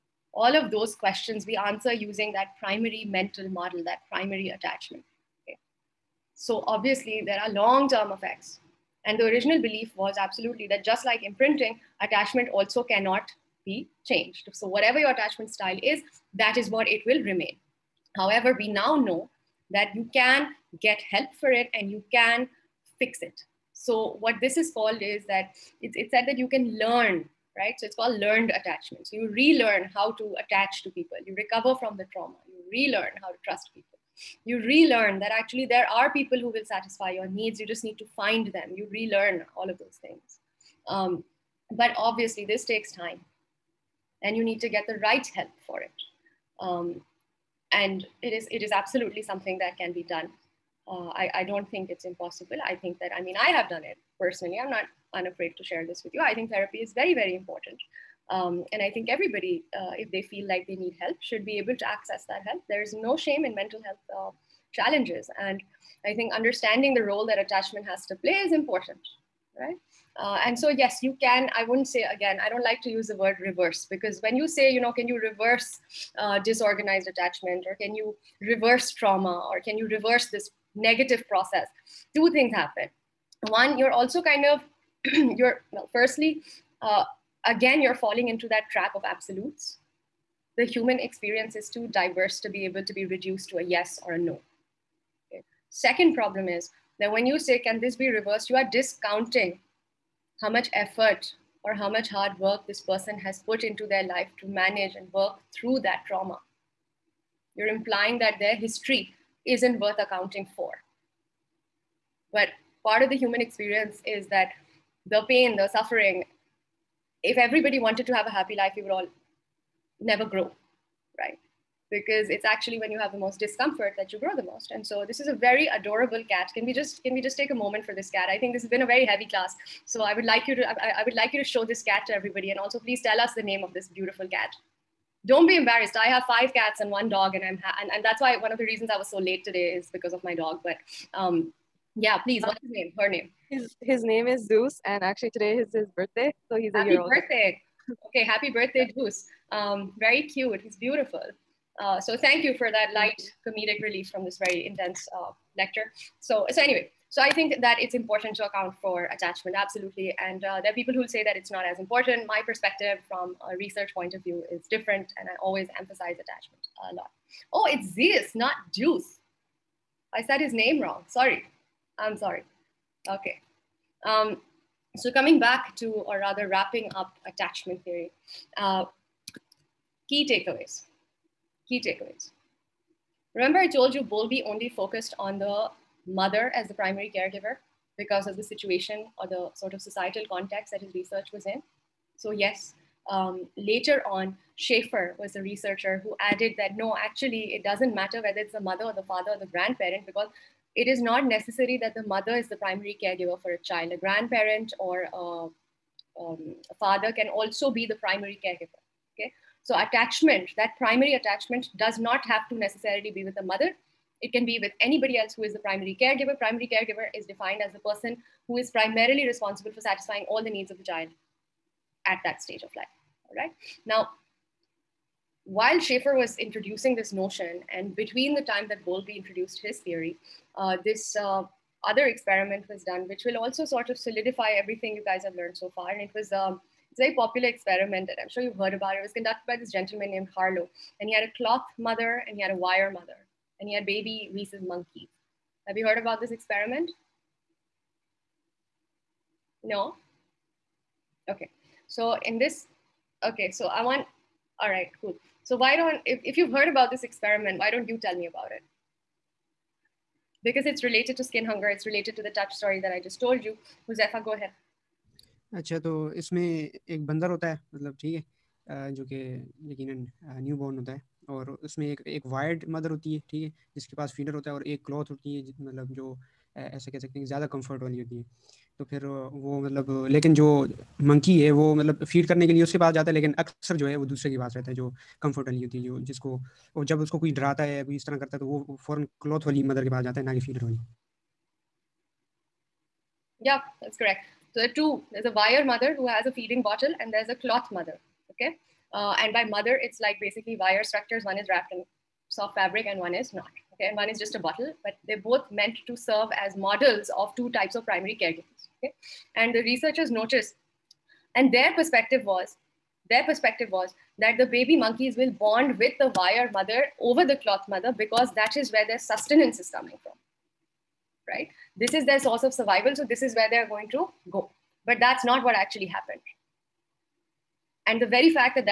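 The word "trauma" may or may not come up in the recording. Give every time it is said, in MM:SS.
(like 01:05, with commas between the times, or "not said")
00:32, 01:18, 01:46.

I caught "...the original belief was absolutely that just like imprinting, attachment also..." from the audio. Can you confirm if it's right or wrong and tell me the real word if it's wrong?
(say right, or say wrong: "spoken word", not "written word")
right.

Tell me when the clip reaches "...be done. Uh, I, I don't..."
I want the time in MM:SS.
00:49.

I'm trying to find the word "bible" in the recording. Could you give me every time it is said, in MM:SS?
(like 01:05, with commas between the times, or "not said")
not said.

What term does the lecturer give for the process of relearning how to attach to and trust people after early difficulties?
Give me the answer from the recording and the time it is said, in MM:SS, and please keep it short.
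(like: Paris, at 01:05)
learned attachment, at 00:28.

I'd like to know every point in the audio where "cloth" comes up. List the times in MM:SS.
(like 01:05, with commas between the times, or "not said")
04:01, 04:57, 05:17.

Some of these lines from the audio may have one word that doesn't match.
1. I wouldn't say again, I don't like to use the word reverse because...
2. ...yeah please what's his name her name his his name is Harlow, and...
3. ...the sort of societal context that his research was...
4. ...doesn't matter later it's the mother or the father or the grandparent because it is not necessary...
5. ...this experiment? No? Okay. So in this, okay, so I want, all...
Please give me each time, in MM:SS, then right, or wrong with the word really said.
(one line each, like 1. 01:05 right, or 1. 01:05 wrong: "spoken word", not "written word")
1. 01:11 right
2. 02:22 wrong: "Zeus", not "Harlow"
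3. 03:09 right
4. 03:17 wrong: "whether", not "later"
5. 04:06 right.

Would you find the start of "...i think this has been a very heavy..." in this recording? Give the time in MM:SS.
02:08.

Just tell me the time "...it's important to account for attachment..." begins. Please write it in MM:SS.
02:37.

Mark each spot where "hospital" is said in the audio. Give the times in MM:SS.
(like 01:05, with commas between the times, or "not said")
not said.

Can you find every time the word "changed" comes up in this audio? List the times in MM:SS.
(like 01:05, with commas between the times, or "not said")
00:14.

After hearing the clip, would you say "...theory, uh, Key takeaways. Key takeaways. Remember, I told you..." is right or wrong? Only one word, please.
right.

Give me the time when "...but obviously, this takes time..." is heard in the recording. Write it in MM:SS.
00:41.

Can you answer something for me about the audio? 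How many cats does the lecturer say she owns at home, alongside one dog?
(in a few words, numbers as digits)
5.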